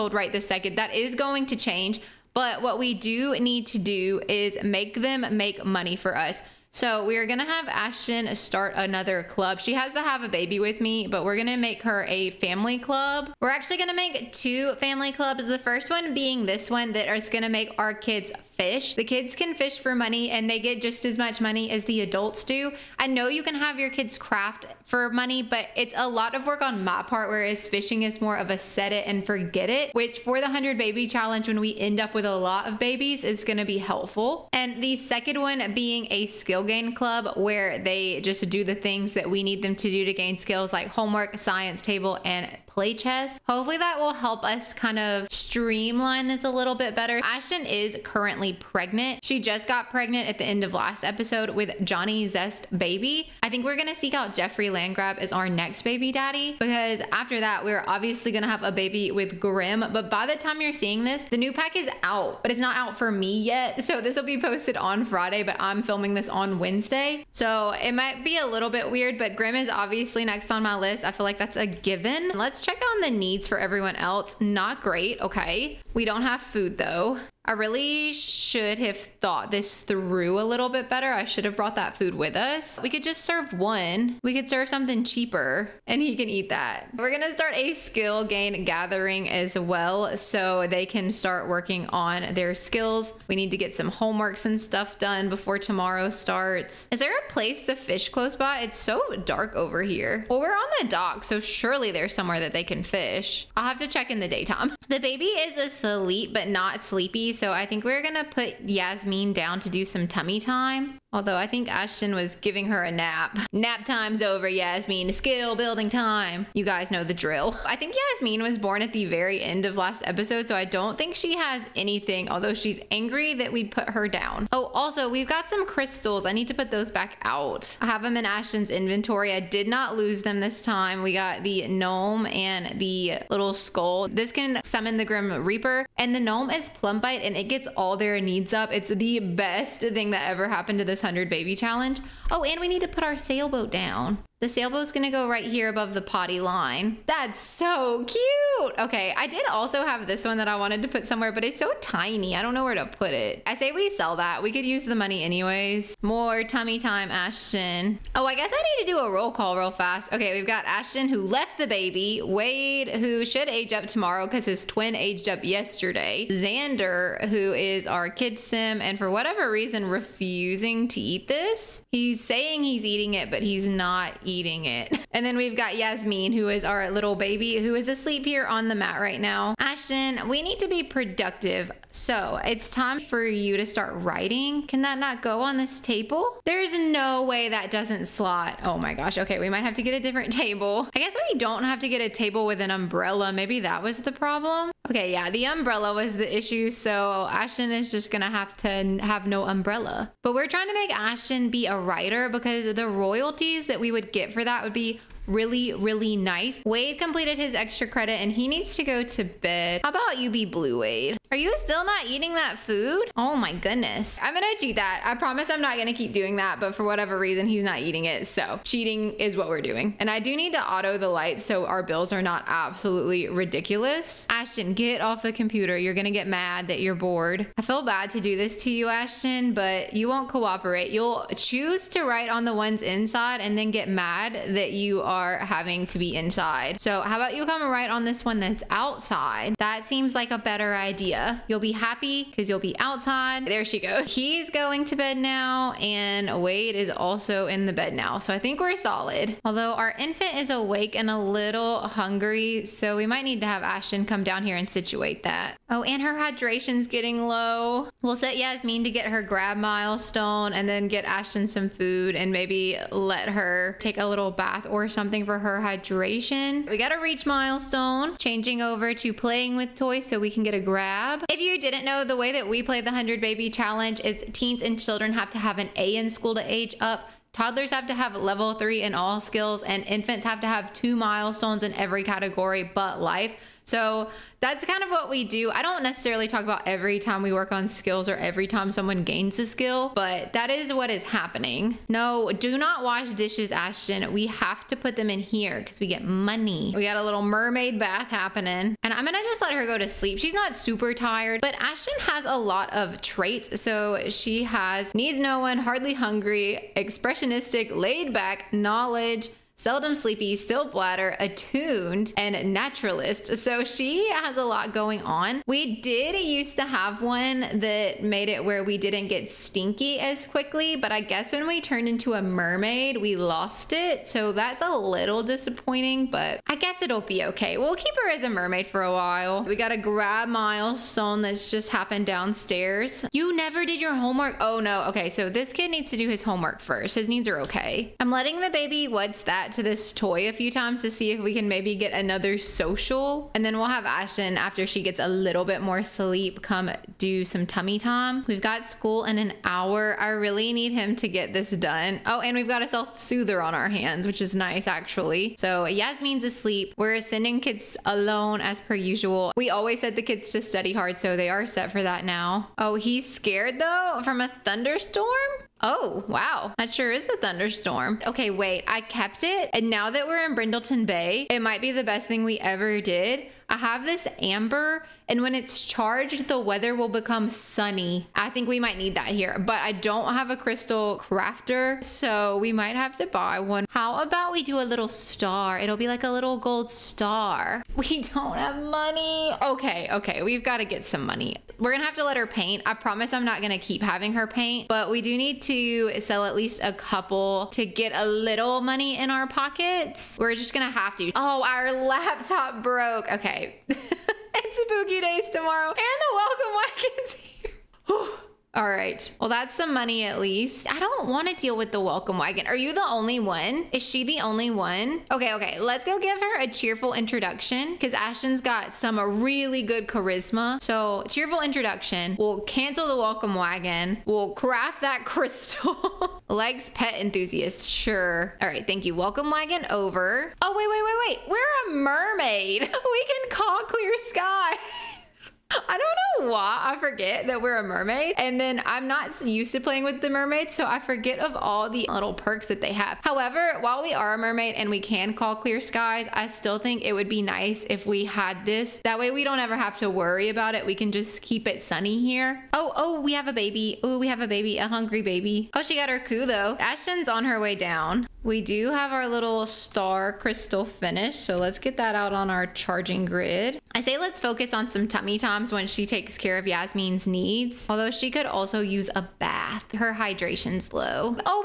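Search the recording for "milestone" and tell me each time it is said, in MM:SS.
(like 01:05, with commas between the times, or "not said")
04:19, 04:27, 04:40, 05:30.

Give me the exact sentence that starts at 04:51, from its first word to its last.
No, do not wash dishes, Ashton.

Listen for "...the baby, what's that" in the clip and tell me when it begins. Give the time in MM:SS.
05:38.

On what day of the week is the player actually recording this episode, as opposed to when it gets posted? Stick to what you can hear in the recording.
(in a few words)
Wednesday.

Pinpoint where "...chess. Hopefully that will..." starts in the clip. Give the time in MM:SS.
00:42.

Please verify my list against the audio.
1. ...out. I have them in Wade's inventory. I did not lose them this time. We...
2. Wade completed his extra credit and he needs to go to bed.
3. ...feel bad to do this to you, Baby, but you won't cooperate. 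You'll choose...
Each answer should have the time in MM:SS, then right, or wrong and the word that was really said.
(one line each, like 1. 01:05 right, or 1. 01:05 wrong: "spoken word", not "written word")
1. 02:07 wrong: "Ashton", not "Wade"
2. 03:26 right
3. 03:47 wrong: "Ashton", not "Baby".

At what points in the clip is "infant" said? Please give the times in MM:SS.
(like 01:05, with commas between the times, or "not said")
04:09, 04:39.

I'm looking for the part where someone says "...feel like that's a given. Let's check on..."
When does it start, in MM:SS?
01:11.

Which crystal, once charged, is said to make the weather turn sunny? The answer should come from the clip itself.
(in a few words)
amber.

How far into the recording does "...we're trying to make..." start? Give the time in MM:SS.
03:20.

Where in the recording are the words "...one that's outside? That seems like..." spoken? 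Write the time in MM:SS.
03:58.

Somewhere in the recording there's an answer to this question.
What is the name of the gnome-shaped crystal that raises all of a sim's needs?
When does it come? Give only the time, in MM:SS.
02:16.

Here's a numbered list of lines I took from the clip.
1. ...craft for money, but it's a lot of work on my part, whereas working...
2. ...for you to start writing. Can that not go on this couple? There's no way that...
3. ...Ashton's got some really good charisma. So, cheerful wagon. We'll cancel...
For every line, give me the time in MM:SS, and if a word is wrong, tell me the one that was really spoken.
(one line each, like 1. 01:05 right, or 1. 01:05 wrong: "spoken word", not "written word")
1. 00:24 wrong: "fishing", not "working"
2. 03:03 wrong: "table", not "couple"
3. 06:57 wrong: "introduction", not "wagon".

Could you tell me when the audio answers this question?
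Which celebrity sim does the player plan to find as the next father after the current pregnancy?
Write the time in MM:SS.
00:54.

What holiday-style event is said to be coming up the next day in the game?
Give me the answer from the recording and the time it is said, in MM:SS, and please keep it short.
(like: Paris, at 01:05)
Spooky Days, at 06:44.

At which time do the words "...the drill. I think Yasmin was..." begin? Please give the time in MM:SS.
01:57.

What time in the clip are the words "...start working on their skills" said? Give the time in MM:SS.
01:31.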